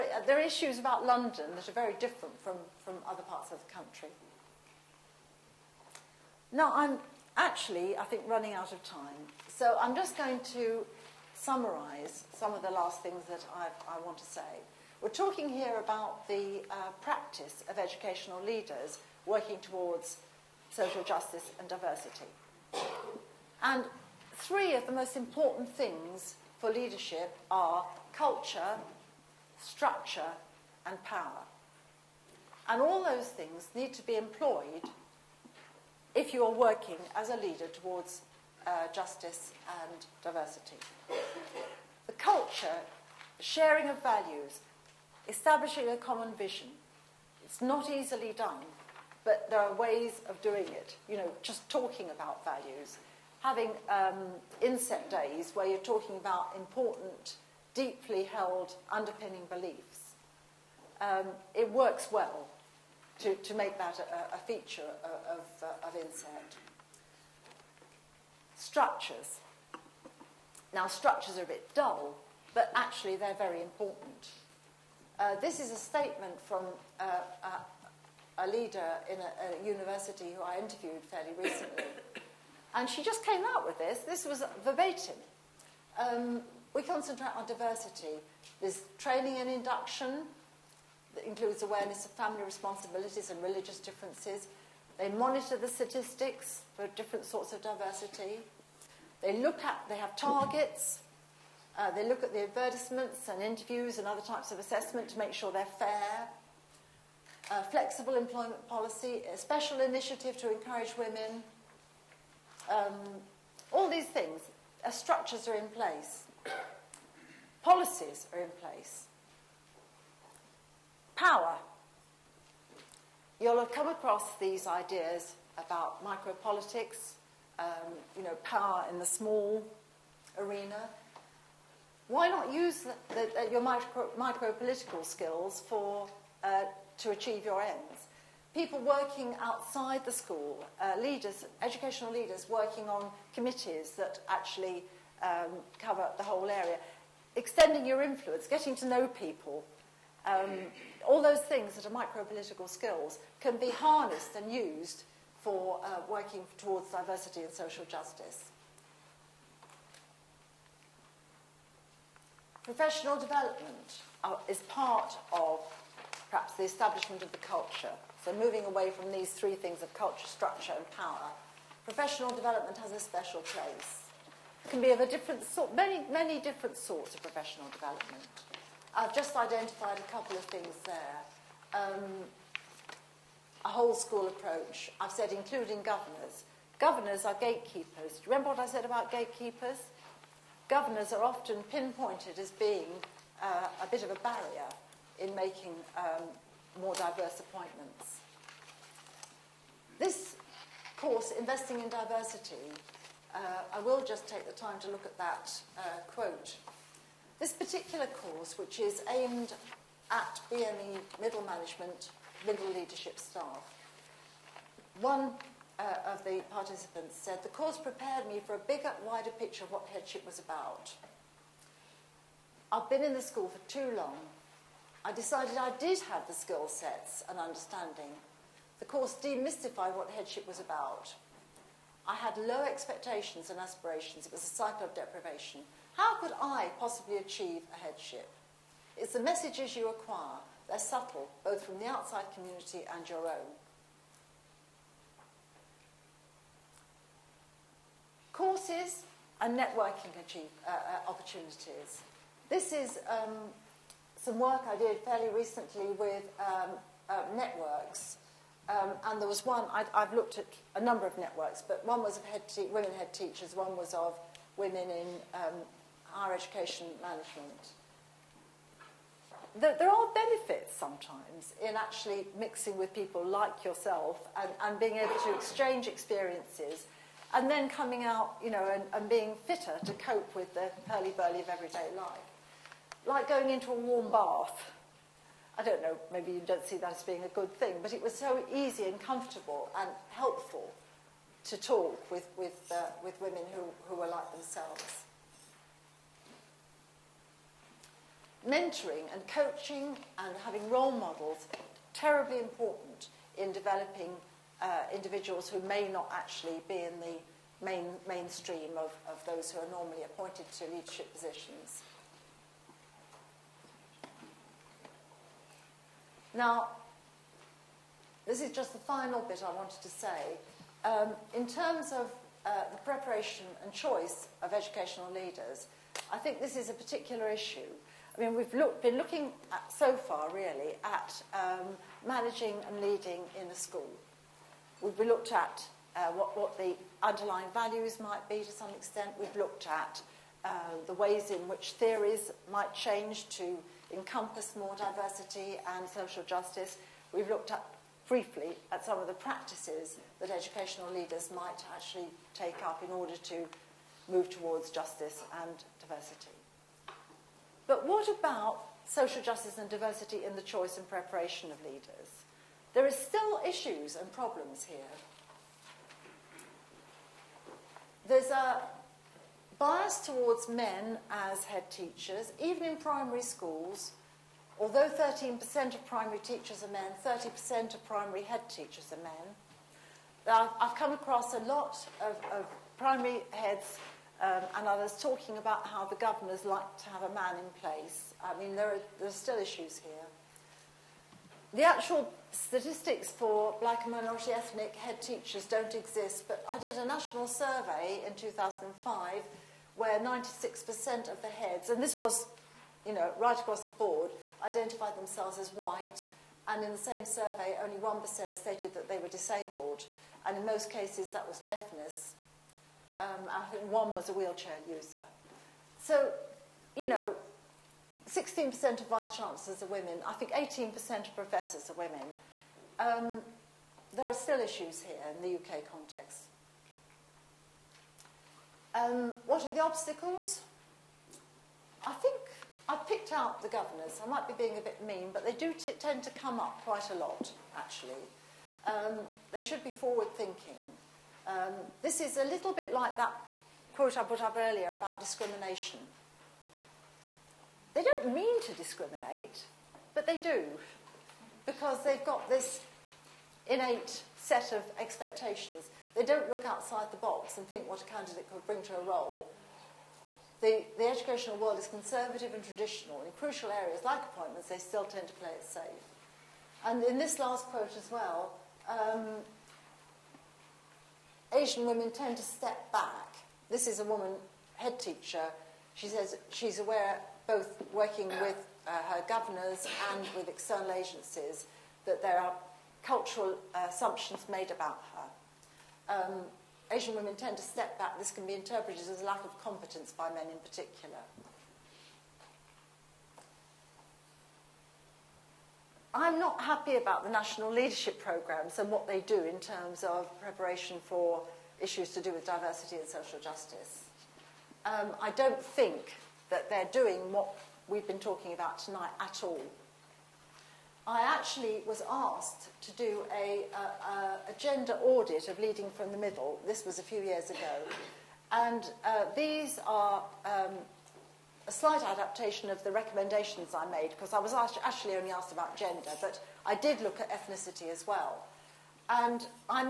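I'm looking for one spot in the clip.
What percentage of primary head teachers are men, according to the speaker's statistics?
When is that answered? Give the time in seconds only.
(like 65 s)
377 s.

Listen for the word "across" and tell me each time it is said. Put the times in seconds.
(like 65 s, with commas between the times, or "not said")
123 s, 380 s, 403 s.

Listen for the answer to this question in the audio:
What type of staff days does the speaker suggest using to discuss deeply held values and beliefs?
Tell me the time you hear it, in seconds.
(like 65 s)
54 s.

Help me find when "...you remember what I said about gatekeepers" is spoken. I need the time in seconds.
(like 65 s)
188 s.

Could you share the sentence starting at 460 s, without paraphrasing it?
The, the educational world is conservative and traditional.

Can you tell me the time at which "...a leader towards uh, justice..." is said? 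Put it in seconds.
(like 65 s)
37 s.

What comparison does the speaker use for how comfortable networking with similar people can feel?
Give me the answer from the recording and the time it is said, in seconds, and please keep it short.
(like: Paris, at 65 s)
A warm bath, at 283 s.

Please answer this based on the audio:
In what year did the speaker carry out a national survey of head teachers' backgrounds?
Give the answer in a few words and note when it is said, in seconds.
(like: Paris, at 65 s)
2005, at 398 s.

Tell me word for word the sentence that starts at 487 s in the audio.
This can be interpreted as a lack of competence by men in particular.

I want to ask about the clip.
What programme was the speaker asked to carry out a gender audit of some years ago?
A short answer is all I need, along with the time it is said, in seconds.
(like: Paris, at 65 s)
Leading from the Middle, at 515 s.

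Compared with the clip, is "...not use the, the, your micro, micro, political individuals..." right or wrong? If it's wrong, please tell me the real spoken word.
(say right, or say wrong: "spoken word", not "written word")
wrong: "skills", not "individuals".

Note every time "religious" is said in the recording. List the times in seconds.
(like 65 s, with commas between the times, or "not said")
93 s.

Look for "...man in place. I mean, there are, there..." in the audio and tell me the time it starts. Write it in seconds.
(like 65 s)
387 s.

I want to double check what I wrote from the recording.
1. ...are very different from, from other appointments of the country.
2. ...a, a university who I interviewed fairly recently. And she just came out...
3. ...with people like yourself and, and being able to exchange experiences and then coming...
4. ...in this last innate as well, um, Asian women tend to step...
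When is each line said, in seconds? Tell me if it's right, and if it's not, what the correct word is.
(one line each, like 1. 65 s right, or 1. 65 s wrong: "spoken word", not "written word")
1. 1 s wrong: "parts", not "appointments"
2. 79 s right
3. 272 s right
4. 466 s wrong: "quote", not "innate".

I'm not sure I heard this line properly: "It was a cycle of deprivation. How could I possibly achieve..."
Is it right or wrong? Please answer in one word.
right.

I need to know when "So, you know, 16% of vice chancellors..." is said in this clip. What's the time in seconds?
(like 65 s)
415 s.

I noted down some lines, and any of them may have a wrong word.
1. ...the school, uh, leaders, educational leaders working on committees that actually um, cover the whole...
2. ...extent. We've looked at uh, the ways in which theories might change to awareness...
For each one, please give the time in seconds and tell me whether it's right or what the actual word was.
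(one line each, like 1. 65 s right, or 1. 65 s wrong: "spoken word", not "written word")
1. 140 s right
2. 338 s wrong: "encompass", not "awareness".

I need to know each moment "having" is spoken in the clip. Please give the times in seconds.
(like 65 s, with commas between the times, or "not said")
53 s, 300 s.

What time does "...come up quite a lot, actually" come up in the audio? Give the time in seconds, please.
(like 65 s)
436 s.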